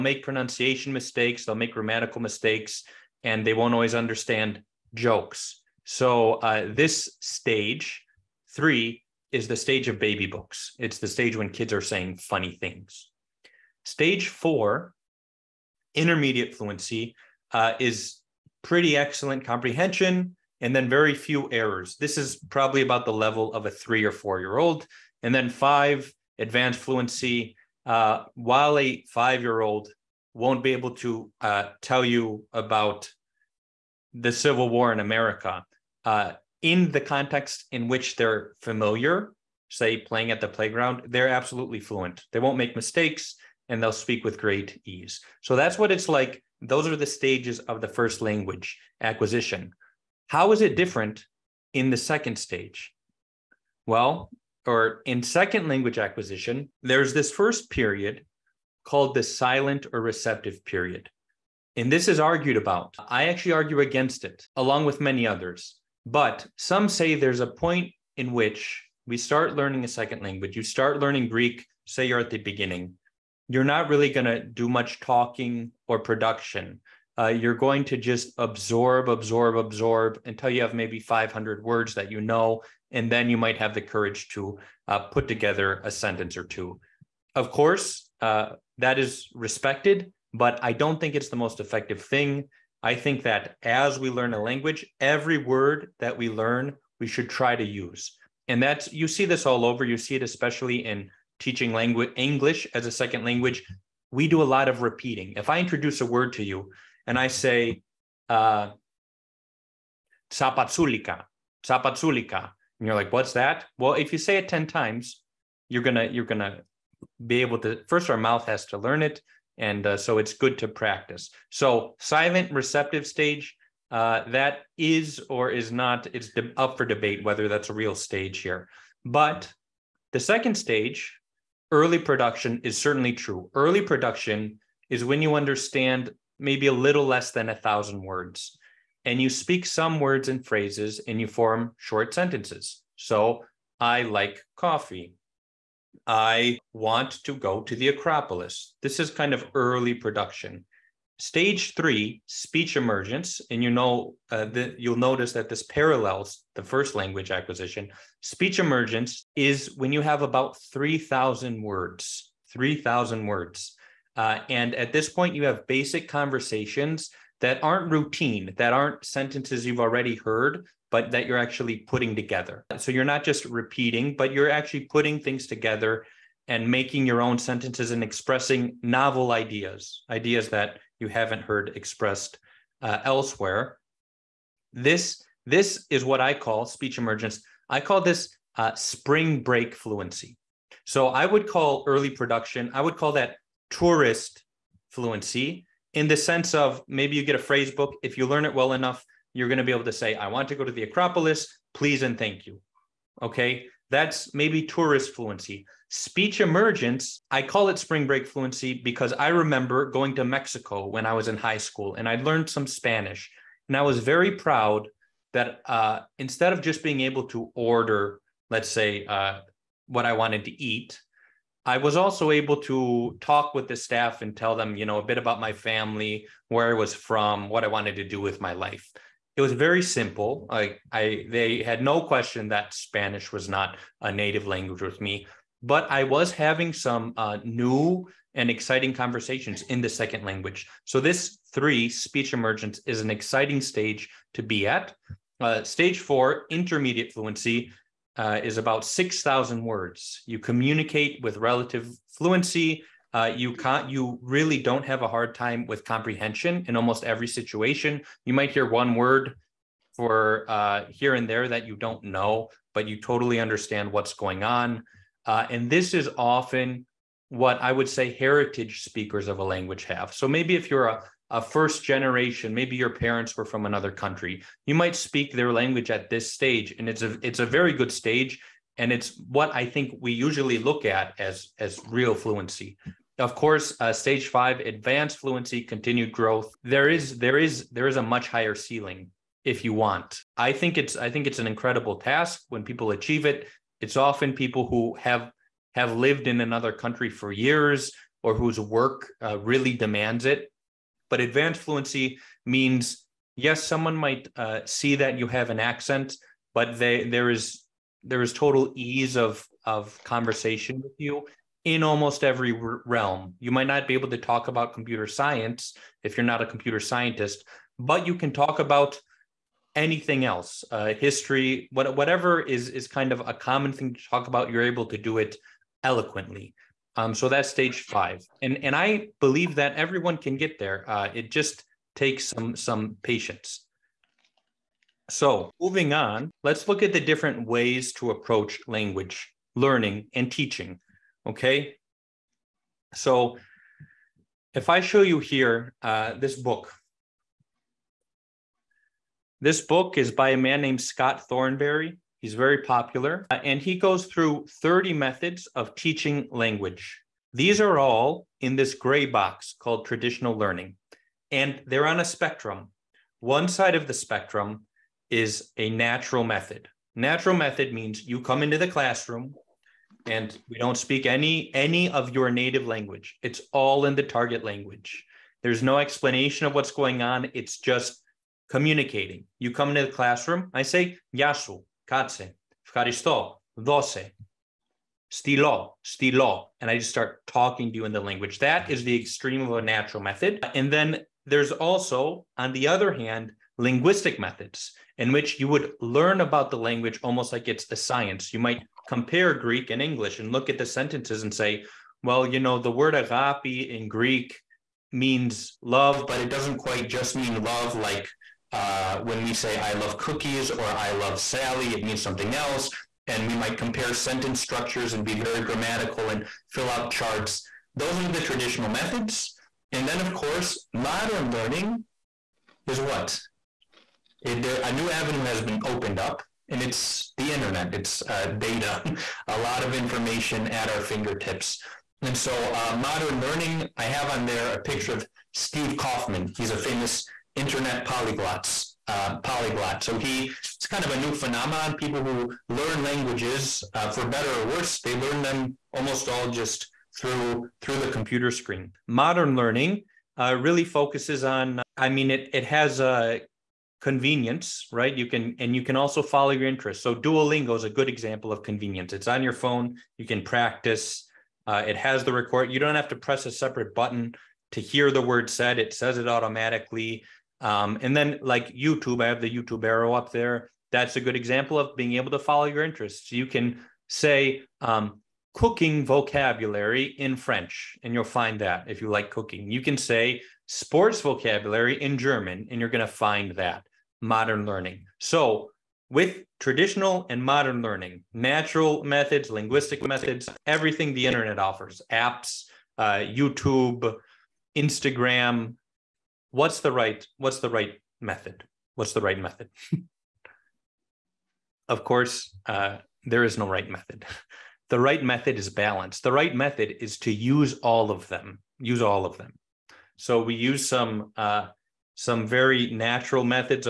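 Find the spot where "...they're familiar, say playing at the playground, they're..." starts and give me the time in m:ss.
0:38.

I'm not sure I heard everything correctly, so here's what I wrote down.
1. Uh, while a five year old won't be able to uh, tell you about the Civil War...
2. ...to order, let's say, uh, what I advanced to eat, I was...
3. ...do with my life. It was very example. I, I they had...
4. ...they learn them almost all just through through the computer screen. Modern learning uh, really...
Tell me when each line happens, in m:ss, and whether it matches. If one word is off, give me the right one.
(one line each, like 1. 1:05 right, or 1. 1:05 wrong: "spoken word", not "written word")
1. 0:27 right
2. 3:37 wrong: "wanted", not "advanced"
3. 3:48 wrong: "simple", not "example"
4. 7:24 right.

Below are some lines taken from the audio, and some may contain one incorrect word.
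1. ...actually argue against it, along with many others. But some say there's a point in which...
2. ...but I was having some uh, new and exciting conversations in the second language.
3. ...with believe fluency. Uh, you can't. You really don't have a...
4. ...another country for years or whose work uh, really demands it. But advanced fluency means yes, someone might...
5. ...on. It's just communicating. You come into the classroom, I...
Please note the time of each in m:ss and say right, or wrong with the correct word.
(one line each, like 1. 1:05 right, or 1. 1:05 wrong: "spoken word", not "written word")
1. 1:03 right
2. 3:55 right
3. 4:11 wrong: "relative", not "believe"
4. 4:56 right
5. 6:17 right.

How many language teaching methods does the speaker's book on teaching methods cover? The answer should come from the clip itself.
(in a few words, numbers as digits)
30.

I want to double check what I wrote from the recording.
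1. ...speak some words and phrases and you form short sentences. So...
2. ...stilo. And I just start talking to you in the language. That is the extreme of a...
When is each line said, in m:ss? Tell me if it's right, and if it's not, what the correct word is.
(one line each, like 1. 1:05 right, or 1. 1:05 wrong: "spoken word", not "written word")
1. 2:19 right
2. 6:25 right.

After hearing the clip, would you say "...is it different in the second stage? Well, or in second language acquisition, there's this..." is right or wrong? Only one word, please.
right.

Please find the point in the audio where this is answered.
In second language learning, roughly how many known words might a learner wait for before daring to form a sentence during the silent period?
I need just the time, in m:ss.
1:20.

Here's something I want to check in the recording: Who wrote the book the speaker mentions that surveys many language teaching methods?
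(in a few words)
Scott Thornbury.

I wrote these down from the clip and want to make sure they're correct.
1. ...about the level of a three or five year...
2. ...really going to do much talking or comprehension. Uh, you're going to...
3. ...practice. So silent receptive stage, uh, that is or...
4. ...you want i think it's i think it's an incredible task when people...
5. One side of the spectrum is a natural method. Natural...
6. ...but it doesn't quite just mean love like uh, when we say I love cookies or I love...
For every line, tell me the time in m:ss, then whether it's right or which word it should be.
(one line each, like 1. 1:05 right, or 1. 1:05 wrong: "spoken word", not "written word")
1. 0:22 wrong: "four", not "five"
2. 1:13 wrong: "production", not "comprehension"
3. 2:00 right
4. 4:49 right
5. 6:03 right
6. 6:46 right.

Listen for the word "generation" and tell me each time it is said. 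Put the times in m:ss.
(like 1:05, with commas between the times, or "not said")
4:31.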